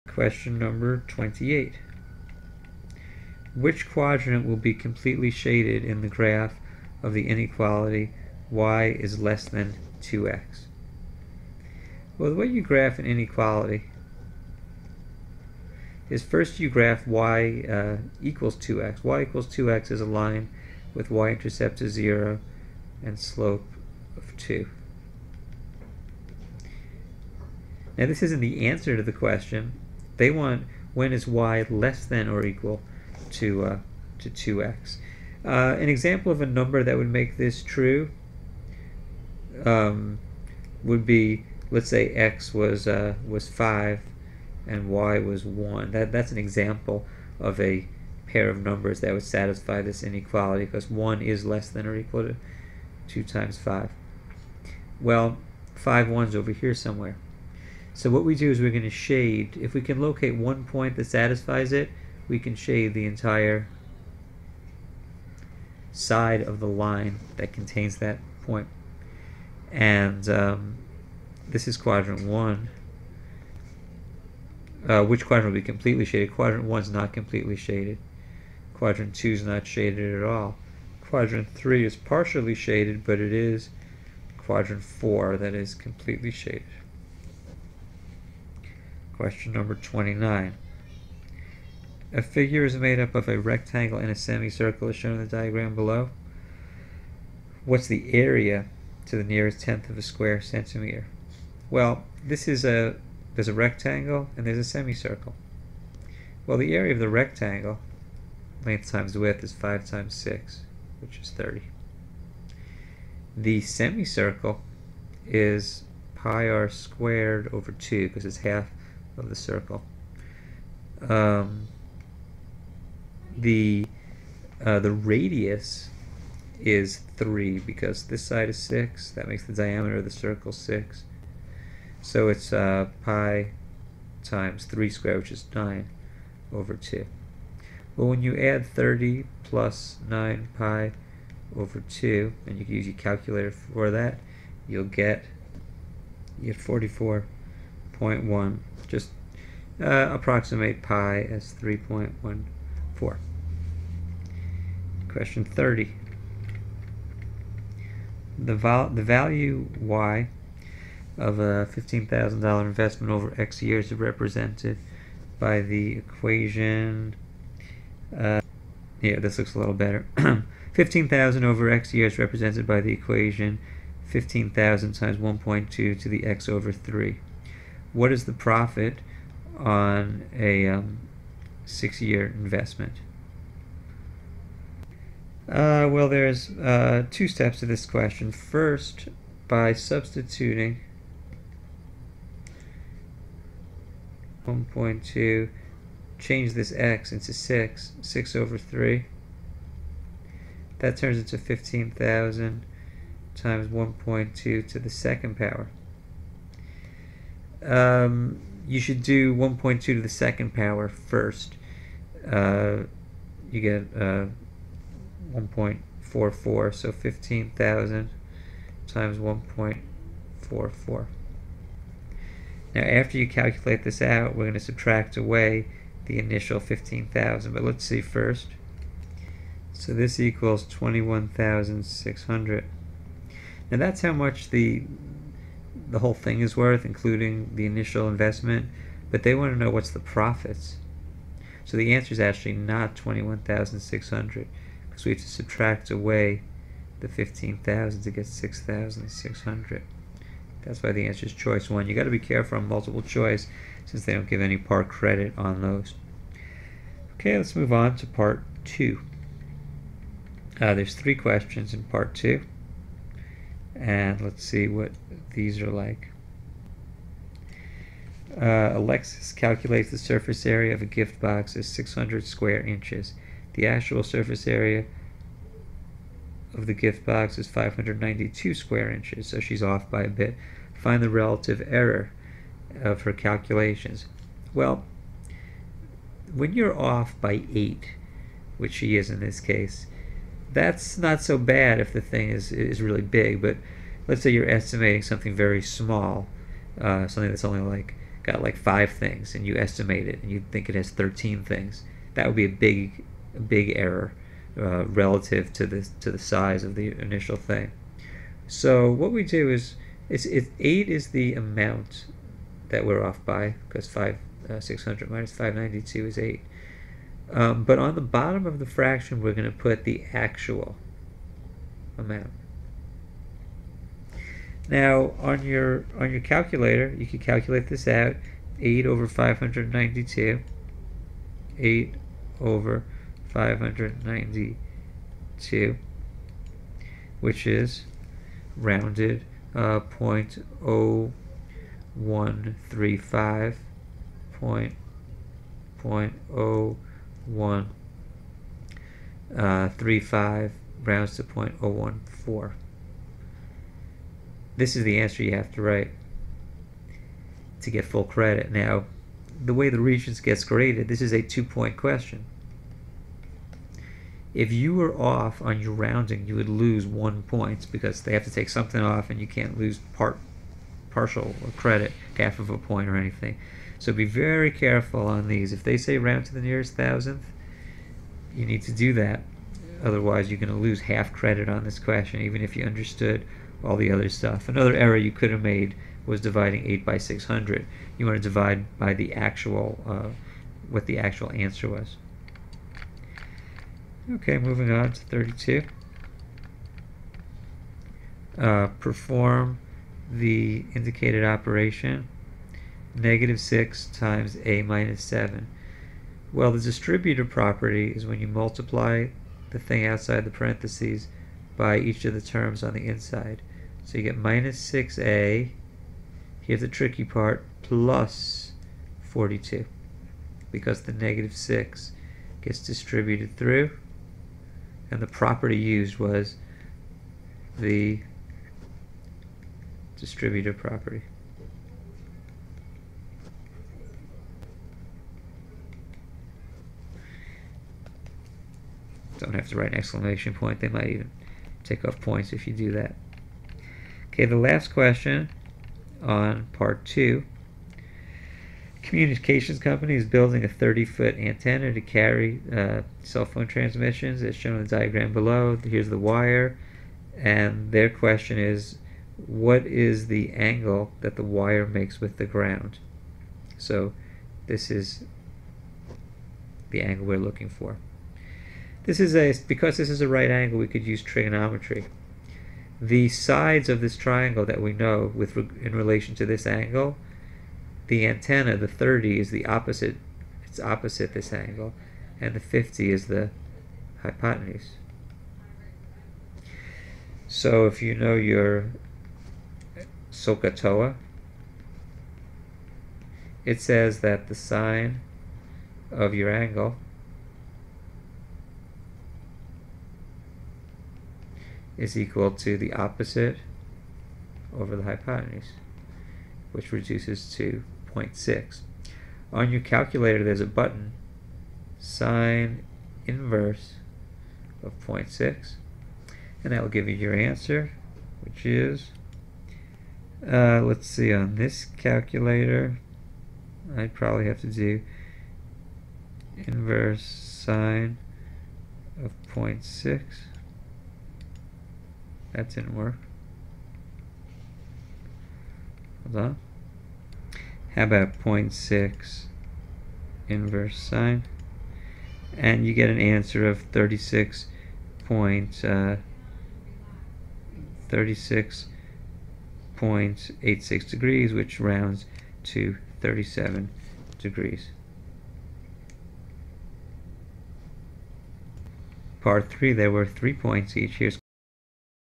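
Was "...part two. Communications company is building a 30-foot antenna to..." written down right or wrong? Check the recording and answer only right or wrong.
right.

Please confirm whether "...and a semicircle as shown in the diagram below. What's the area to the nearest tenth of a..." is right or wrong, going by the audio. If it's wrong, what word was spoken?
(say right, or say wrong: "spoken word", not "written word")
right.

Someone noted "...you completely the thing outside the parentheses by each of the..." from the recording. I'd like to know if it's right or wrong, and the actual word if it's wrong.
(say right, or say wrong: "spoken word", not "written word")
wrong: "multiply", not "completely".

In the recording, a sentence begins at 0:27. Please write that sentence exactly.
Now this isn't the answer to the question, they want when is y less than or equal to, uh, to 2x.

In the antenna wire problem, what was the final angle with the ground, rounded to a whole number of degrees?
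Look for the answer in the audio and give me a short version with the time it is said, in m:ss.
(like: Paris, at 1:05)
37 degrees, at 9:13.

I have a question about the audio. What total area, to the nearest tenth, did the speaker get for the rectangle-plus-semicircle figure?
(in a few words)
44.1.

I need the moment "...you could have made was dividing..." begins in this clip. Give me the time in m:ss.
6:24.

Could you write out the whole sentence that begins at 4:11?
You got to be careful on multiple choice since they don't give any part credit on those.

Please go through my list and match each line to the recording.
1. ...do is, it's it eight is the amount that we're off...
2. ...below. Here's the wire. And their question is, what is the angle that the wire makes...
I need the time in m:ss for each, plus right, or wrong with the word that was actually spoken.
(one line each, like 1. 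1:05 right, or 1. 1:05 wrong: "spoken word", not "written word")
1. 5:09 right
2. 7:35 right.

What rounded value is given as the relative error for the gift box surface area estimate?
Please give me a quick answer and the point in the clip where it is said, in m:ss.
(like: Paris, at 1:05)
0.014, at 5:51.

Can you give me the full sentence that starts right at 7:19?
Don't have to write an exclamation point.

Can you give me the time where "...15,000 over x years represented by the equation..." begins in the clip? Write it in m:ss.
2:50.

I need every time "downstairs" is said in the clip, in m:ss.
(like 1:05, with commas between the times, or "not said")
not said.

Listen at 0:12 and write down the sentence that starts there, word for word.
Well, the way you graph an inequality is first you graph y uh, equals 2x.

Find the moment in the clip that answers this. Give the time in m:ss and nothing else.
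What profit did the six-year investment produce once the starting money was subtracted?
4:08.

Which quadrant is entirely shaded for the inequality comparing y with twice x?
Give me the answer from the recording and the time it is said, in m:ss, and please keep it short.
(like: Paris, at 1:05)
quadrant four, at 1:24.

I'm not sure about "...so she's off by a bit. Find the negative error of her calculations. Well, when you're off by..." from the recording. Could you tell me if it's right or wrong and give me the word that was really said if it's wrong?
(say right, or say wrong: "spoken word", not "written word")
wrong: "relative", not "negative".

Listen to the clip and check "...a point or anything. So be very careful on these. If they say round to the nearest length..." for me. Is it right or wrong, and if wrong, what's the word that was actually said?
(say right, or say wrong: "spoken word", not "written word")
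wrong: "thousandth", not "length".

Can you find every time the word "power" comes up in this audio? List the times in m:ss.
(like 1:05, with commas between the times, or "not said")
3:25, 3:30.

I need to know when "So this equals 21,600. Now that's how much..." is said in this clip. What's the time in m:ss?
3:49.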